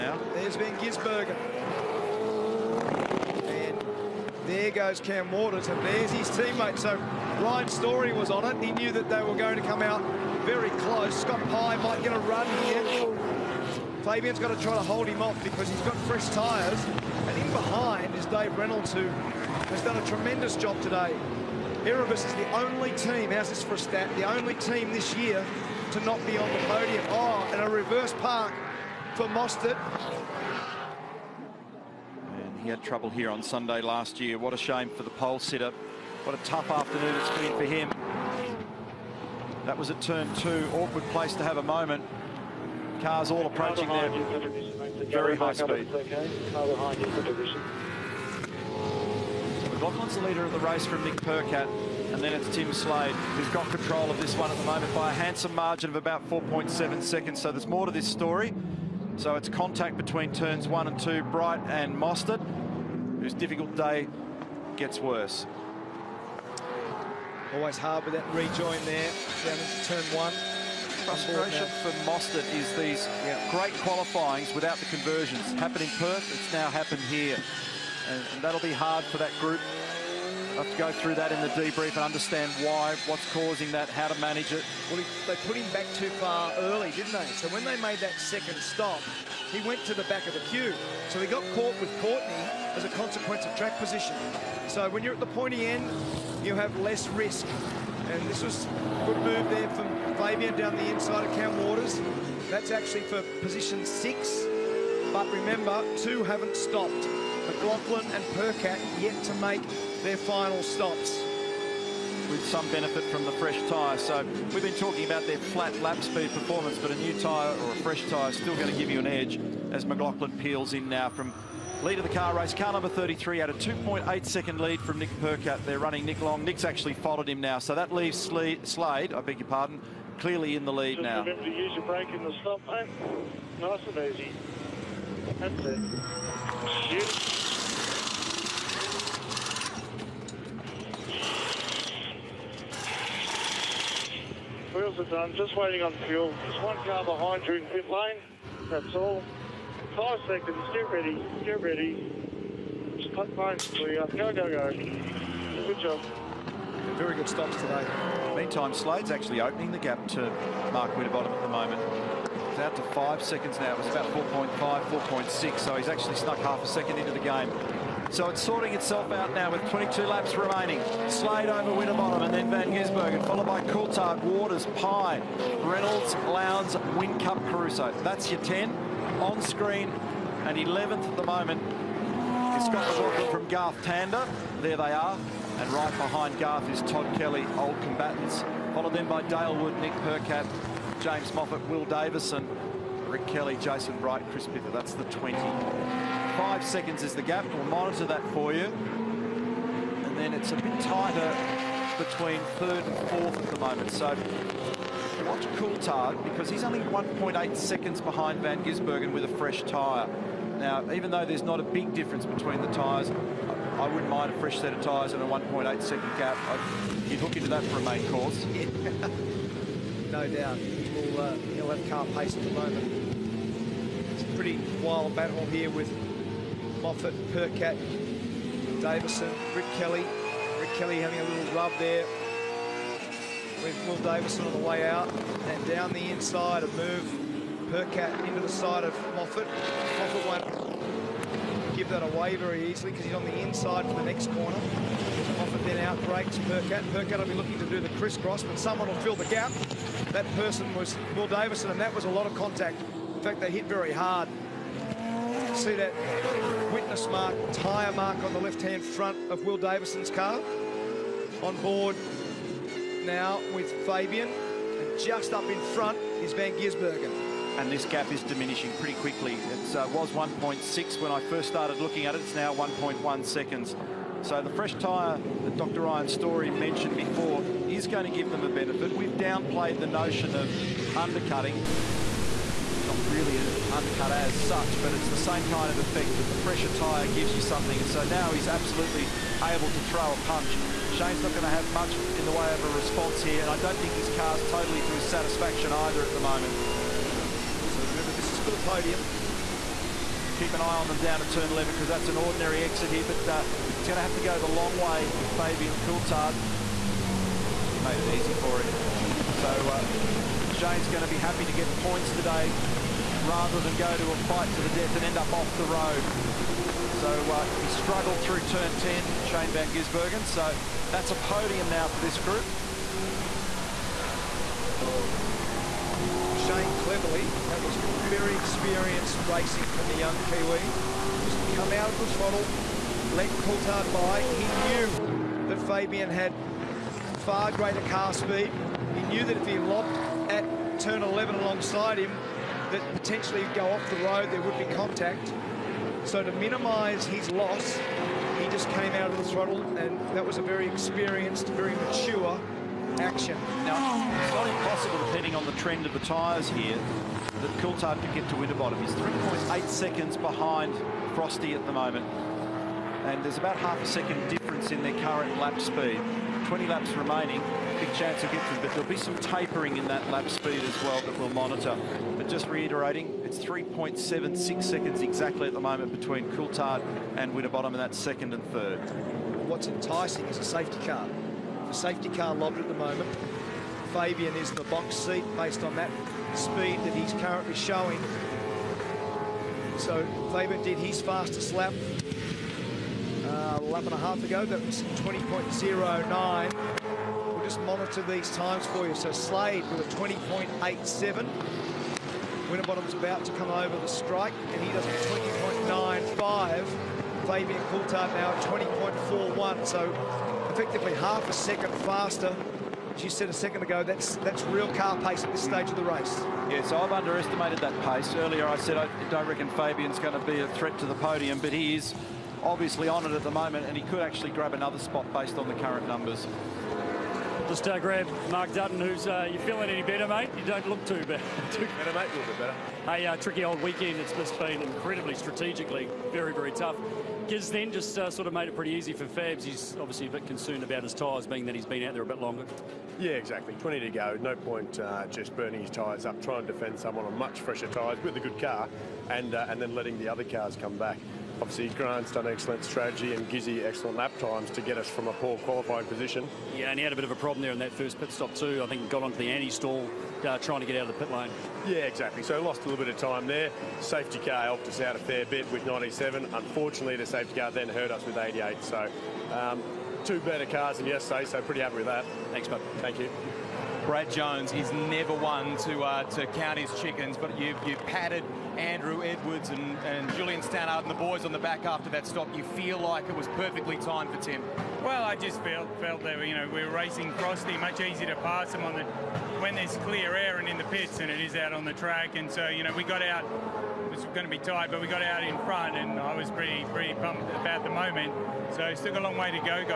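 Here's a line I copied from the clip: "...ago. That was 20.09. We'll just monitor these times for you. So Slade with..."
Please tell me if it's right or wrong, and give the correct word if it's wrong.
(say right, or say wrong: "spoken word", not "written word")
right.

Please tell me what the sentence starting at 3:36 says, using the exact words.
I'd, you'd hook into that for a main course.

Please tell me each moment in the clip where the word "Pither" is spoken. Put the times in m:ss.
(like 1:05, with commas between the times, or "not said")
3:14.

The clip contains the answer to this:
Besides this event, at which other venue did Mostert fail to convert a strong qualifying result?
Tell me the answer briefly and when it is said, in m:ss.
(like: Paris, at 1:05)
Perth, at 1:15.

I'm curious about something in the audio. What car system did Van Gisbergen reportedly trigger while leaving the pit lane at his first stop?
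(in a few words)
Anti-stall.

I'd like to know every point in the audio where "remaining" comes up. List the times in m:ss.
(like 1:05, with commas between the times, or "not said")
2:50, 6:06.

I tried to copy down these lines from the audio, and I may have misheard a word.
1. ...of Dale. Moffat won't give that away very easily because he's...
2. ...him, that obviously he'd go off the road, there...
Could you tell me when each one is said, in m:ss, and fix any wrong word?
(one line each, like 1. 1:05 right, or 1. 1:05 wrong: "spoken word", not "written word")
1. 3:58 wrong: "Moffat", not "Dale"
2. 5:41 wrong: "potentially", not "obviously".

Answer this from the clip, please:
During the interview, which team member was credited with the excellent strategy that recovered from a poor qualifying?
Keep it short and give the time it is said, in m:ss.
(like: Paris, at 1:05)
Grant, at 7:31.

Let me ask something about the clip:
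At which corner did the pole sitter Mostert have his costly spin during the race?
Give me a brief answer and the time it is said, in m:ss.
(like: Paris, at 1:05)
Turn two, at 0:40.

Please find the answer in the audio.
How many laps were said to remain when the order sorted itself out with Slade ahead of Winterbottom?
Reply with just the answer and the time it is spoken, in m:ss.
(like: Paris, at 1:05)
22, at 2:49.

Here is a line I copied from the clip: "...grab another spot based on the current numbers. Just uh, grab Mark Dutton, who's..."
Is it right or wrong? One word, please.
right.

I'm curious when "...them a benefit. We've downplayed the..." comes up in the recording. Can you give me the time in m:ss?
4:38.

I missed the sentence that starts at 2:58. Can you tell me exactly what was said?
That's your 10 on screen and 11th at the moment got the McLaughlin from Garth Tander.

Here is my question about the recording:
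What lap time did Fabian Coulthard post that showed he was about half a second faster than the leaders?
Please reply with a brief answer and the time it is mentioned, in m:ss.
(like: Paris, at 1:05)
20.41, at 6:48.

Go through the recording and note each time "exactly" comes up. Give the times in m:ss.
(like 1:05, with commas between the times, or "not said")
6:15, 7:23, 7:41.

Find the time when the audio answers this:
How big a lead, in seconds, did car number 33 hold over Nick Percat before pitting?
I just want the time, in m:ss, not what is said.
2:03.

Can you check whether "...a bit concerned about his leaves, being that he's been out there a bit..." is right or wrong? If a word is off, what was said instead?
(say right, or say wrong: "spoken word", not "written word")
wrong: "tyres", not "leaves".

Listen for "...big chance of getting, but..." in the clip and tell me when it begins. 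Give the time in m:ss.
6:07.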